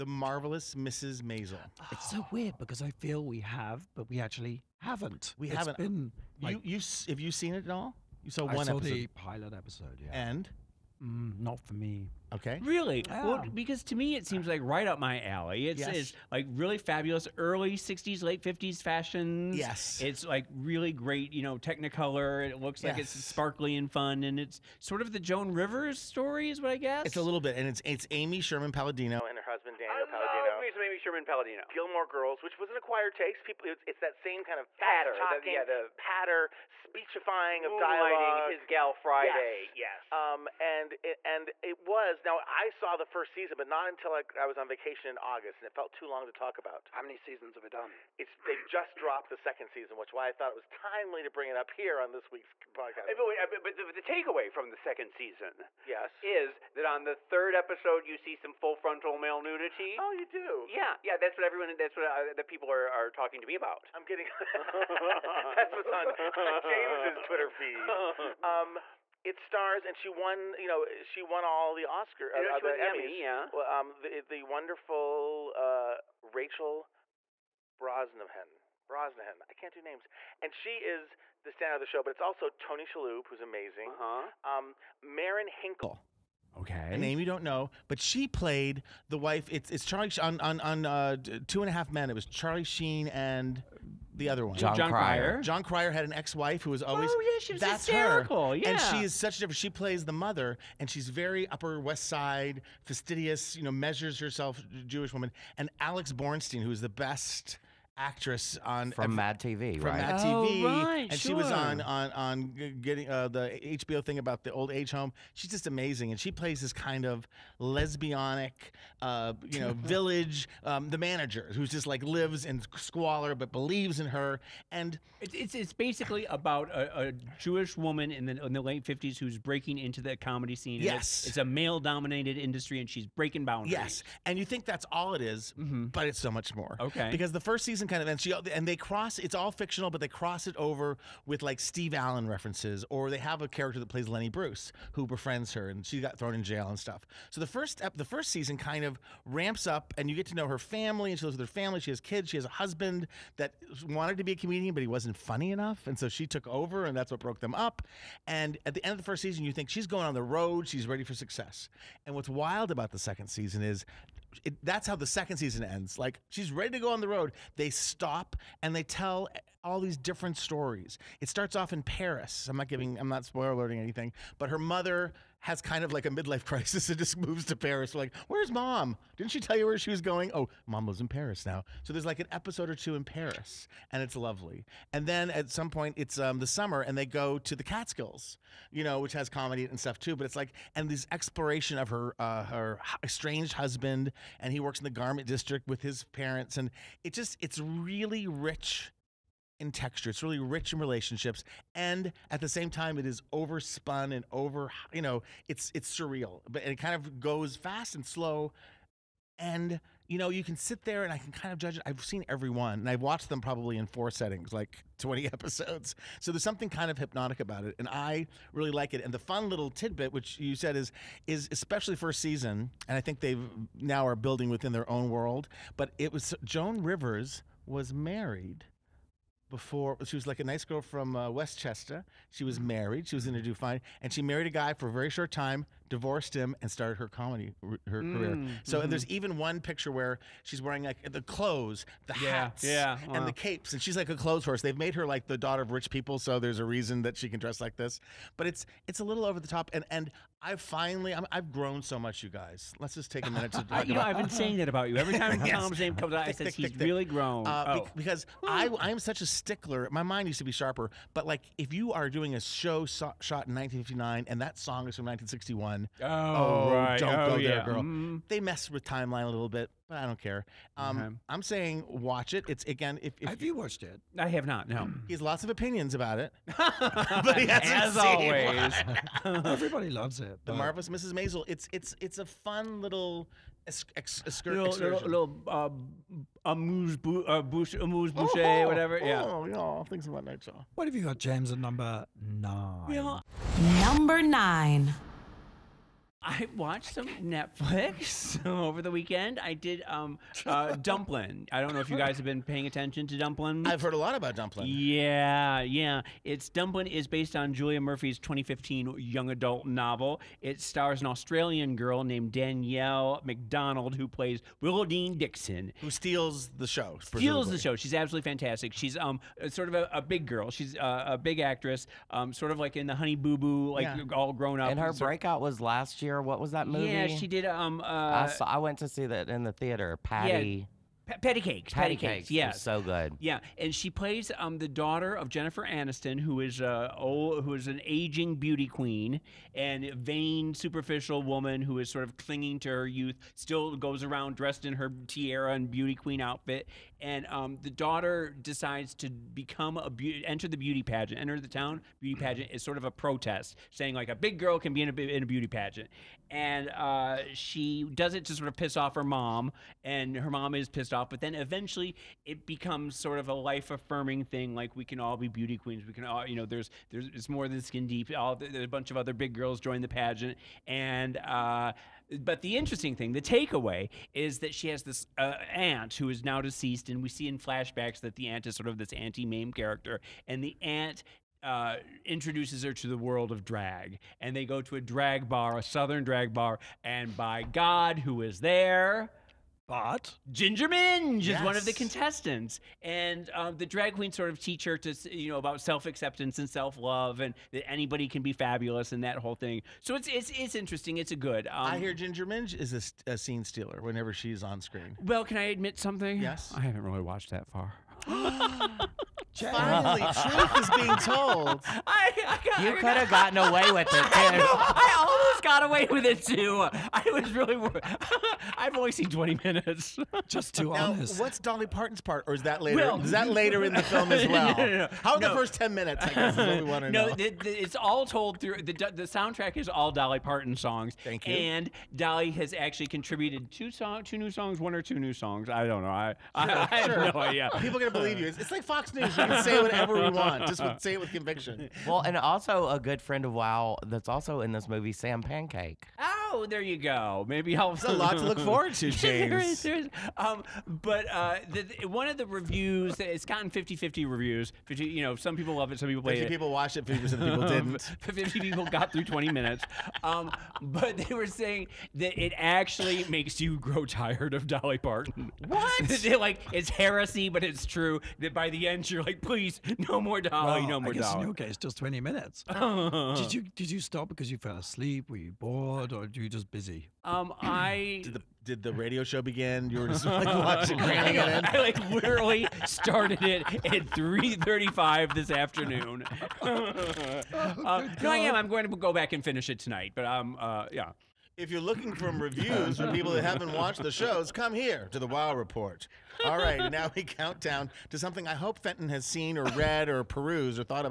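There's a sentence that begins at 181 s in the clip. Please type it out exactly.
So there's like an episode or two in Paris, and it's lovely.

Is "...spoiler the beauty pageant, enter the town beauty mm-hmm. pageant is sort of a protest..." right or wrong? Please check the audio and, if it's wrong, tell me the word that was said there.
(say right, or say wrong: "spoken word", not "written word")
wrong: "enter", not "spoiler".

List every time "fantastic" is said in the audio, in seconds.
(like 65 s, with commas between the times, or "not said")
318 s.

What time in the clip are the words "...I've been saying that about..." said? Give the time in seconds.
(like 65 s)
254 s.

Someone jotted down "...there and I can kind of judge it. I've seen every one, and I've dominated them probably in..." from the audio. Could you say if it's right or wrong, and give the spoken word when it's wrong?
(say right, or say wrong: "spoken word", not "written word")
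wrong: "watched", not "dominated".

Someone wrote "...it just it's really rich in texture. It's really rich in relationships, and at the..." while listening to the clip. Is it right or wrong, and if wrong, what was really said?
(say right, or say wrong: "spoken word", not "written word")
right.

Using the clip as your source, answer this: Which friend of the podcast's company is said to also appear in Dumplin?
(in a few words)
Sam Pancake.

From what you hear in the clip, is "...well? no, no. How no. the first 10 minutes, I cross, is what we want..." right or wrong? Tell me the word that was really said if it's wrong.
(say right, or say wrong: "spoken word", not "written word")
wrong: "guess", not "cross".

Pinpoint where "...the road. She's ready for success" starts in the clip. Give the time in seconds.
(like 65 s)
160 s.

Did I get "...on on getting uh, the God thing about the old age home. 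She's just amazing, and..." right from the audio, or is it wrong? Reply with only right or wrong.
wrong.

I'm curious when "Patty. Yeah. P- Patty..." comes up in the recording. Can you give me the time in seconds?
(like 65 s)
330 s.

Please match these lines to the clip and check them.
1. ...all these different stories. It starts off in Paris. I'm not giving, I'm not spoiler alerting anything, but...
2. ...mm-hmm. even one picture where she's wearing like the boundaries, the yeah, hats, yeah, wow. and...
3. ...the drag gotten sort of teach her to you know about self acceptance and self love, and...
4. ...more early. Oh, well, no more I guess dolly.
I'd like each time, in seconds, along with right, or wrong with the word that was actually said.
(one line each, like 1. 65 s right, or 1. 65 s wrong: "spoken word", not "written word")
1. 169 s right
2. 239 s wrong: "clothes", not "boundaries"
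3. 393 s wrong: "queen", not "gotten"
4. 470 s wrong: "dolly", not "early".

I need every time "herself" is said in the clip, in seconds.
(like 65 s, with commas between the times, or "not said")
104 s.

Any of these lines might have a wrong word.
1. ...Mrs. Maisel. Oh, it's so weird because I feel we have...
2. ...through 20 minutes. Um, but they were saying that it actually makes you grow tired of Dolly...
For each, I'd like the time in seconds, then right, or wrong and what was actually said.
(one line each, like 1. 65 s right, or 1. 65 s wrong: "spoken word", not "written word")
1. 0 s right
2. 458 s right.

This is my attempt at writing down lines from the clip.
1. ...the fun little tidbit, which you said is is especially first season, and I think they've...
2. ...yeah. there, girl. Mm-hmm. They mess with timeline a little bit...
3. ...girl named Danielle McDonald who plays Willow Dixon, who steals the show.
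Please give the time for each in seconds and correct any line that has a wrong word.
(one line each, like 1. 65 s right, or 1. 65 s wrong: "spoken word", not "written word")
1. 219 s right
2. 267 s right
3. 311 s right.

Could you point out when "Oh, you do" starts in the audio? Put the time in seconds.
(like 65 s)
60 s.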